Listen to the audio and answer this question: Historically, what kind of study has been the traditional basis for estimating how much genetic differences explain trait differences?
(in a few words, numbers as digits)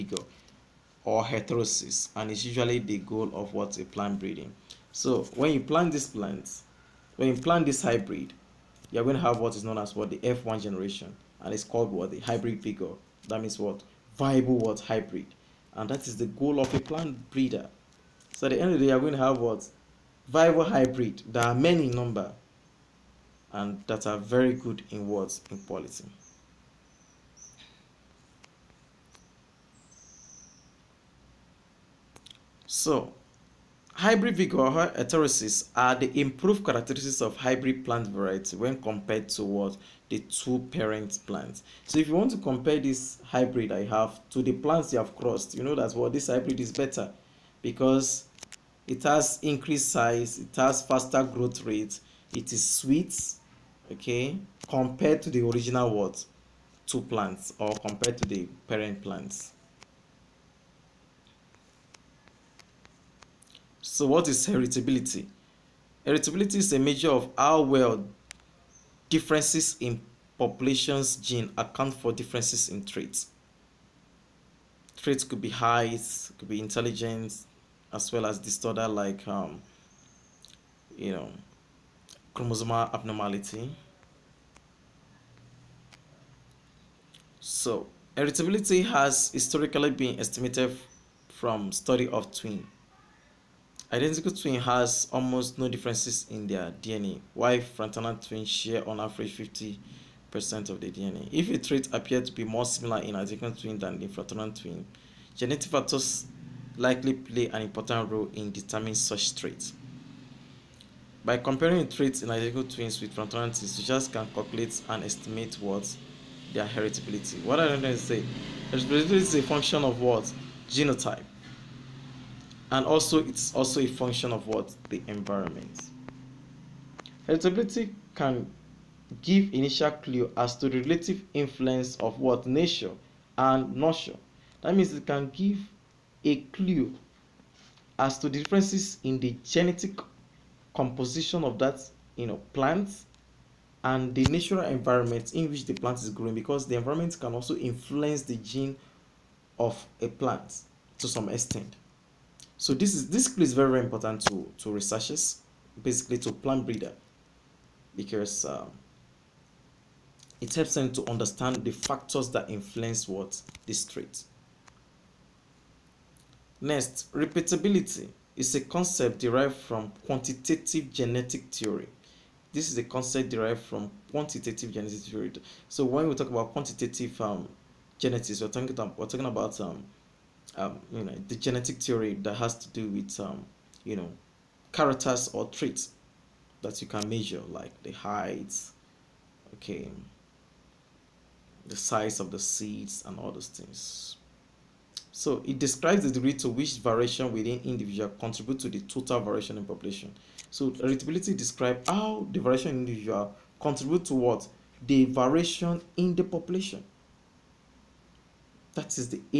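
study of twins.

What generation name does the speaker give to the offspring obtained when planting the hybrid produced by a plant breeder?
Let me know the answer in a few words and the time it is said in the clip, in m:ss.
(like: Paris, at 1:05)
F1 generation, at 0:10.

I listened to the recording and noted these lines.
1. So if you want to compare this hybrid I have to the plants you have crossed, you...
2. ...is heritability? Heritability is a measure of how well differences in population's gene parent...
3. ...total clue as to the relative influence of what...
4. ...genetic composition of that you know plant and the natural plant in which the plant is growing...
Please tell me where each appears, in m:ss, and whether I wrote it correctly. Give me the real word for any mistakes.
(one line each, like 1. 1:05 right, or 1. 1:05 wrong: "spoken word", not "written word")
1. 0:41 right
2. 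1:04 wrong: "account", not "parent"
3. 2:09 wrong: "initial", not "total"
4. 2:19 wrong: "environment", not "plant".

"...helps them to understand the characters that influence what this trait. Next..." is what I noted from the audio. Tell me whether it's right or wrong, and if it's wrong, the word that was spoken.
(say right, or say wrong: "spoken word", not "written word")
wrong: "factors", not "characters".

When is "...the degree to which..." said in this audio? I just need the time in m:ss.
3:16.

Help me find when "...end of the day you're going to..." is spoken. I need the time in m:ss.
0:18.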